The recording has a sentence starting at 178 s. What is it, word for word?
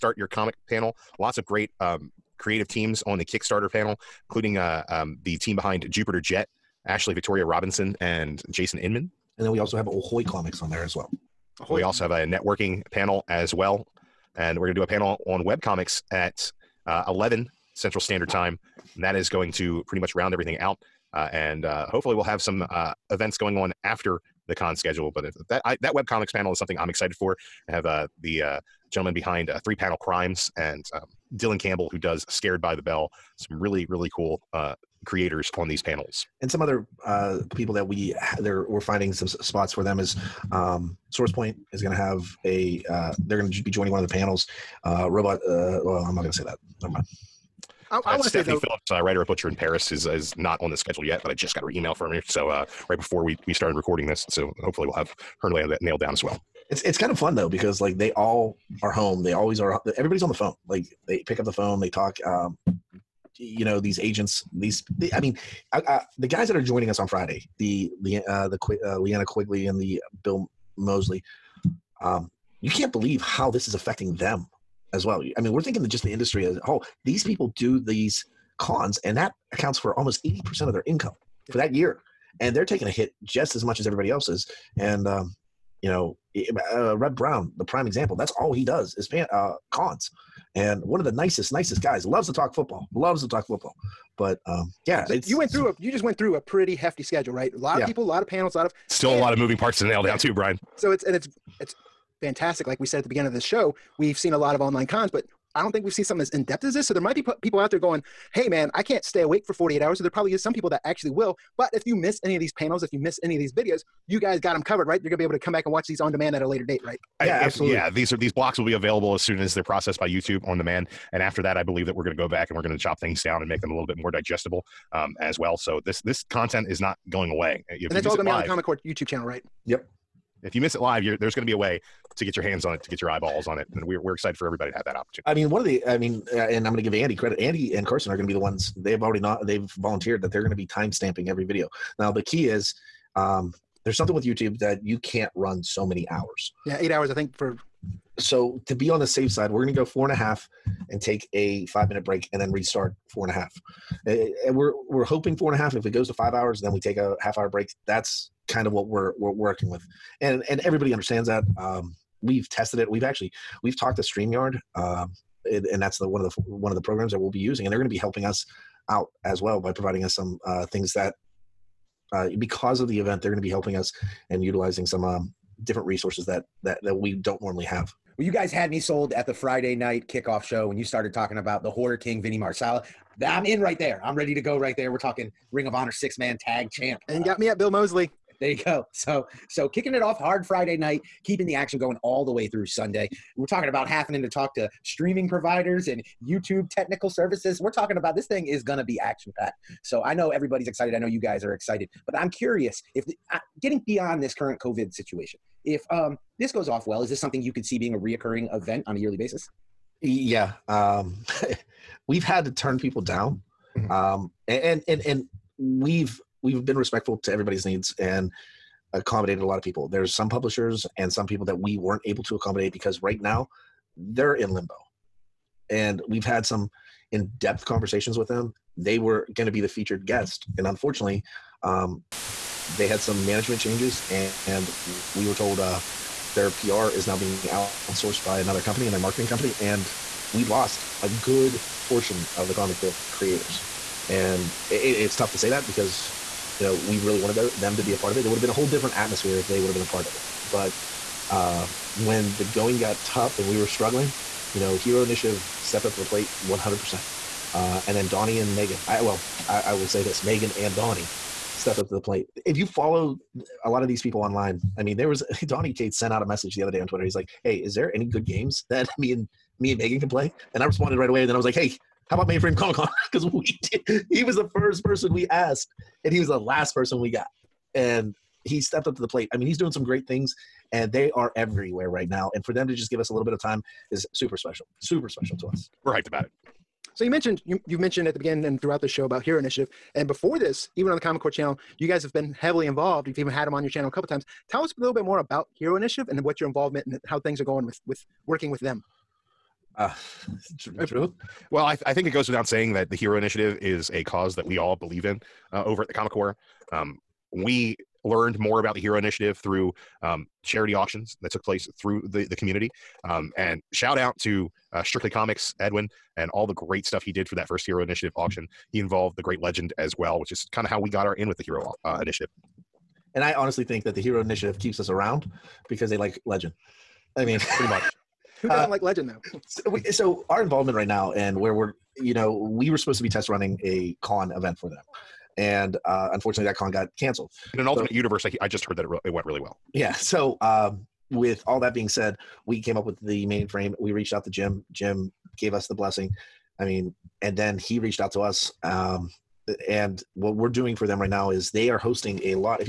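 Well, you guys had me sold at the Friday night kickoff show when you started talking about the Horror King, Vinny Marseglia.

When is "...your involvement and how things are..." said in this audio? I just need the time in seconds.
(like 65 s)
296 s.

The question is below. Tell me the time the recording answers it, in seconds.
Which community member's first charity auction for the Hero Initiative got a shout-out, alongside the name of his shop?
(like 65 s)
315 s.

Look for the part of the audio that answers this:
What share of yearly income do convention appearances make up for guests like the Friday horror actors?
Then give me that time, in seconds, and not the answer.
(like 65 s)
80 s.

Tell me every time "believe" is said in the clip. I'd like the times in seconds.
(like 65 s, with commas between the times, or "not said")
72 s, 121 s, 304 s.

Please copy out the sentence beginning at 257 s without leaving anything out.
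Uh, and then Donny and Megan, I, well, I, I will say this Megan and Donny stepped up to the plate.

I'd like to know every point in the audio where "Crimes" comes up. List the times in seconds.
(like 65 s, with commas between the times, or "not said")
29 s.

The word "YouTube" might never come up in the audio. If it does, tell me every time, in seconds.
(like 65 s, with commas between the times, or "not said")
120 s, 128 s, 144 s, 196 s.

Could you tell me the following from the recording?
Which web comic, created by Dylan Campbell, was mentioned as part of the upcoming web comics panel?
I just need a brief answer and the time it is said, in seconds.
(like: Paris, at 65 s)
Scared by the Bell, at 32 s.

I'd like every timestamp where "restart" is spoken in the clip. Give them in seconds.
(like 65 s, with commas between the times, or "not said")
152 s.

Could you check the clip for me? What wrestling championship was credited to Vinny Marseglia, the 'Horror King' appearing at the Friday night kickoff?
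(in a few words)
Ring of Honor six man tag.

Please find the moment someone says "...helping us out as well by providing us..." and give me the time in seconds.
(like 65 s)
167 s.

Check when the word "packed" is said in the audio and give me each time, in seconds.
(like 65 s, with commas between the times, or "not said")
199 s.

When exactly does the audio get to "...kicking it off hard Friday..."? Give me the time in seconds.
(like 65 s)
189 s.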